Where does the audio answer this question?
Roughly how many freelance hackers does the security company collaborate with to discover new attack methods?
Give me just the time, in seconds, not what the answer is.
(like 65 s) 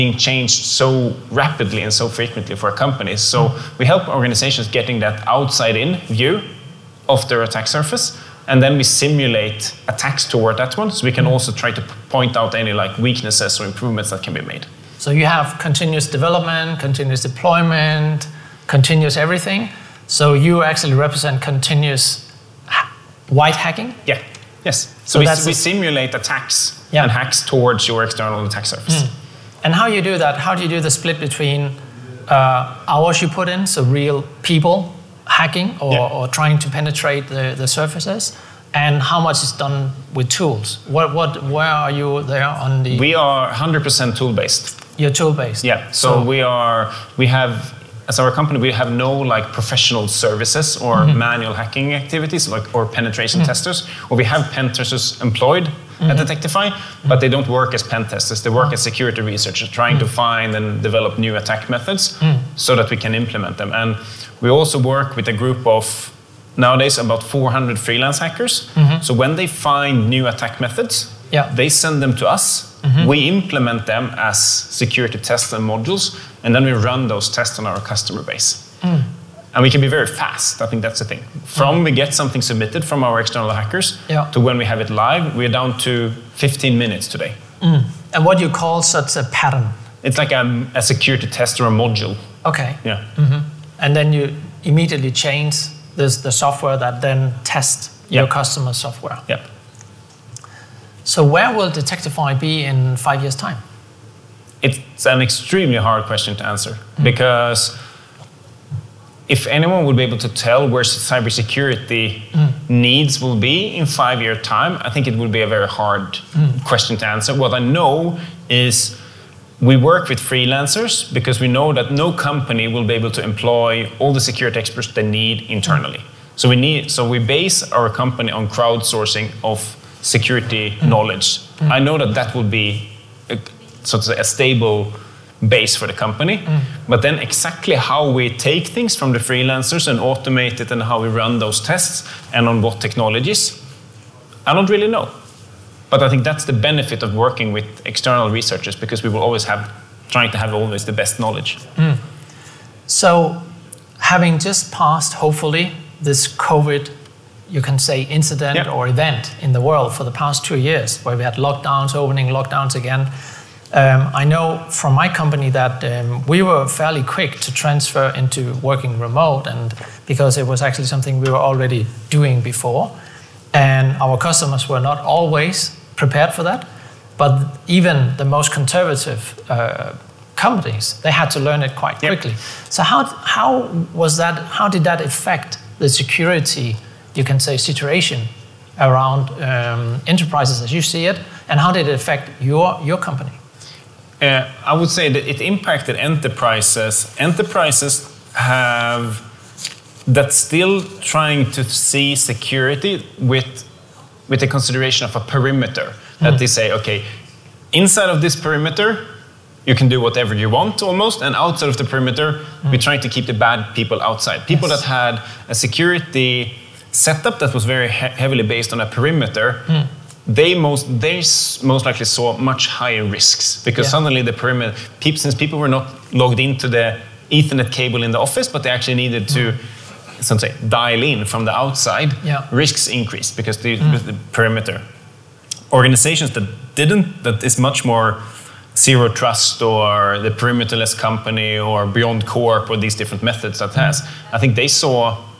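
67 s.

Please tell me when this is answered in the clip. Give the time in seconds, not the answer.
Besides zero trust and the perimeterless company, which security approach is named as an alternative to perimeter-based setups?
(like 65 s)
241 s.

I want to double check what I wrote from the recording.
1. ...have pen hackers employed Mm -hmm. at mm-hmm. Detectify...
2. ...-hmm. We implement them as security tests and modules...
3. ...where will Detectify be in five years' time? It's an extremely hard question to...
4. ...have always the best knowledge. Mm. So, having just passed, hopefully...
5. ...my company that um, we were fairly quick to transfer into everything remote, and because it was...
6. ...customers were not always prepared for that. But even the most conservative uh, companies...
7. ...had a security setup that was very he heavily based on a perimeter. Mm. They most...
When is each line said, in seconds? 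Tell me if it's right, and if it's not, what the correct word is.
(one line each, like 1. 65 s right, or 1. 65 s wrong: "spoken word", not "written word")
1. 54 s wrong: "testers", not "hackers"
2. 72 s right
3. 101 s right
4. 150 s right
5. 164 s wrong: "working", not "everything"
6. 174 s right
7. 214 s right.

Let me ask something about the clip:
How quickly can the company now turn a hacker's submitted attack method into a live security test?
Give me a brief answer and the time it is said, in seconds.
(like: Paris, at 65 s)
15 minutes, at 86 s.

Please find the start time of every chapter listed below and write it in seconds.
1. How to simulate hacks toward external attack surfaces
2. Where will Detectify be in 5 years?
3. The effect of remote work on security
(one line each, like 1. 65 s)
1. 30 s
2. 101 s
3. 153 s.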